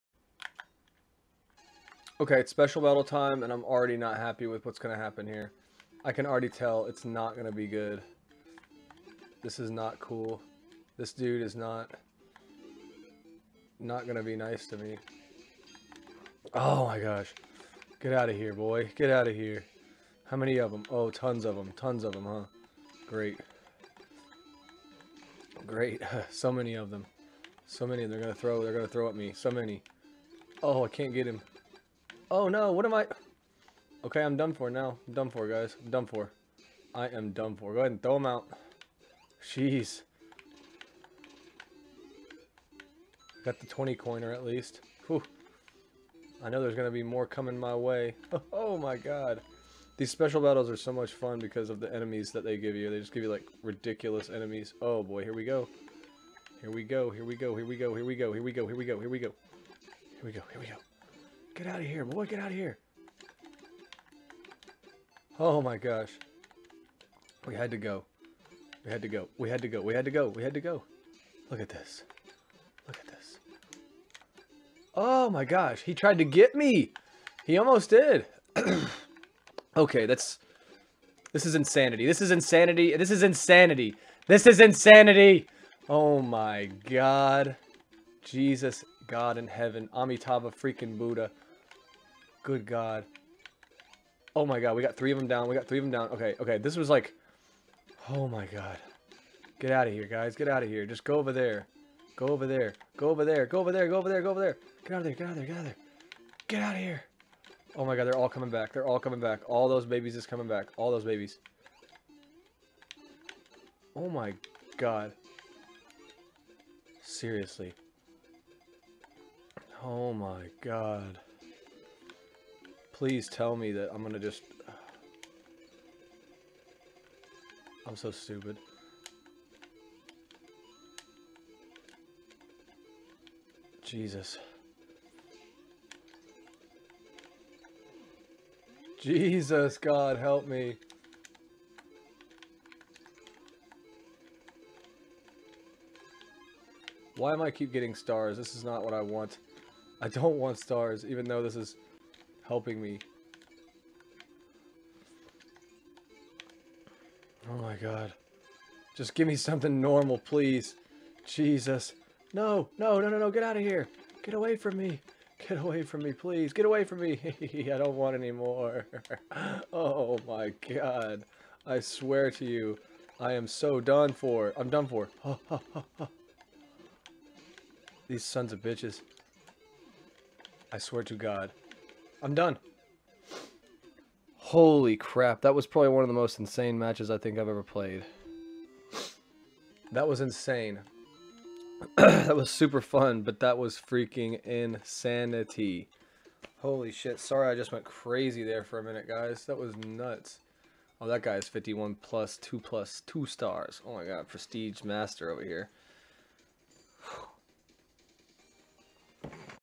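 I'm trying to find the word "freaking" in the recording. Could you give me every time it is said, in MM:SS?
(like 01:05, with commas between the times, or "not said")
01:30, 03:13.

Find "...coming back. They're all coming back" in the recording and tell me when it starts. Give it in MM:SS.
01:48.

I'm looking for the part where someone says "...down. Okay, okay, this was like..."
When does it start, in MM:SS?
01:35.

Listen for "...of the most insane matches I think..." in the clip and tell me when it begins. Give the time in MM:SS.
03:06.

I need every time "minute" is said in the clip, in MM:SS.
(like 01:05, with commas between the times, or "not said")
03:18.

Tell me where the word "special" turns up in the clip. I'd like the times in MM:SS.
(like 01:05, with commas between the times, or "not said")
00:02, 00:50.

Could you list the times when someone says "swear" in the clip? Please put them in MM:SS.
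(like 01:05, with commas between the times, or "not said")
02:51, 03:00.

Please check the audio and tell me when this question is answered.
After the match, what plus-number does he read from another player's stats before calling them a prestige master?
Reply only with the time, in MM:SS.
03:21.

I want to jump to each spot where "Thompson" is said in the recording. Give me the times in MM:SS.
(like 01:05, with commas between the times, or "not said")
not said.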